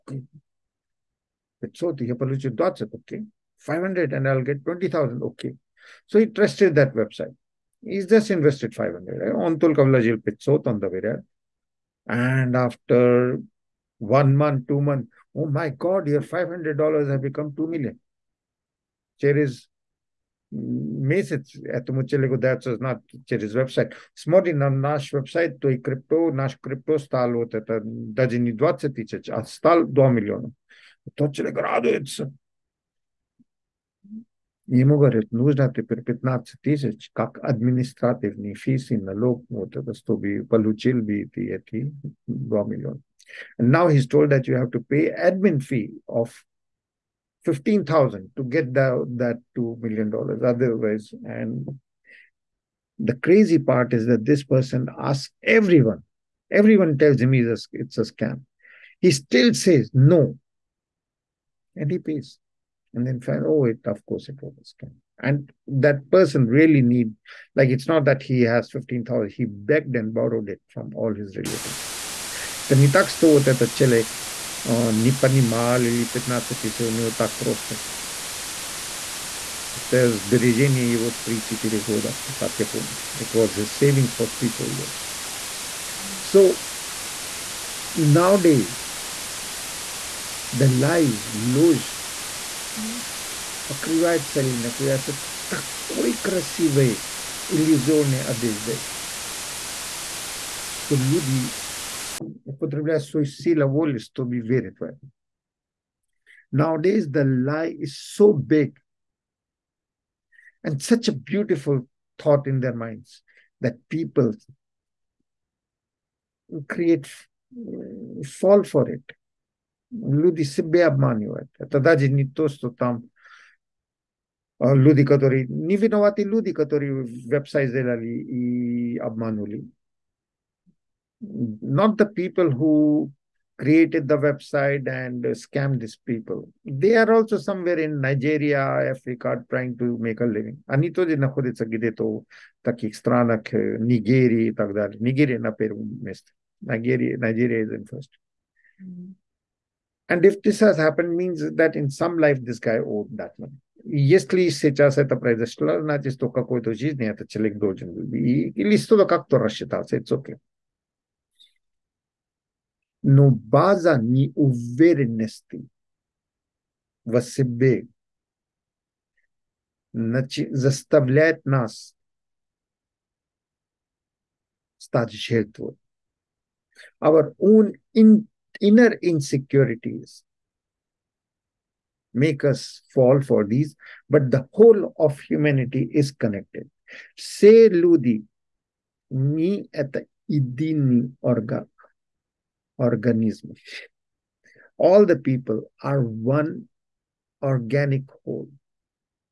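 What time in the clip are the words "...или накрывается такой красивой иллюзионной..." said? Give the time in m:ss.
1:34.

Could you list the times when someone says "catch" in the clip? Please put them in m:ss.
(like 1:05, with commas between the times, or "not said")
not said.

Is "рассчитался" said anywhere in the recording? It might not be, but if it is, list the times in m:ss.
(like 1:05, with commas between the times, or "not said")
2:39.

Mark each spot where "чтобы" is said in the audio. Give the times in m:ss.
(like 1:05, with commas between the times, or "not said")
0:39, 1:43.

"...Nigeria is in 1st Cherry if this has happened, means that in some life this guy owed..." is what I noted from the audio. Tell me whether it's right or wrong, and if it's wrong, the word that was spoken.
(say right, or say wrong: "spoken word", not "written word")
wrong: "And", not "Cherry".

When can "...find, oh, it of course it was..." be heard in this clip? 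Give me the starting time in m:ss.
1:03.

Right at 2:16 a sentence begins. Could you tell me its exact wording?
They are also somewhere in Nigeria, Africa, trying to make a living.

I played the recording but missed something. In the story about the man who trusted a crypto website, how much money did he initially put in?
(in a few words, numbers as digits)
$500.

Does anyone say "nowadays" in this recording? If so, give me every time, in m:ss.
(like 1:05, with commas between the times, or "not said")
1:27, 1:46.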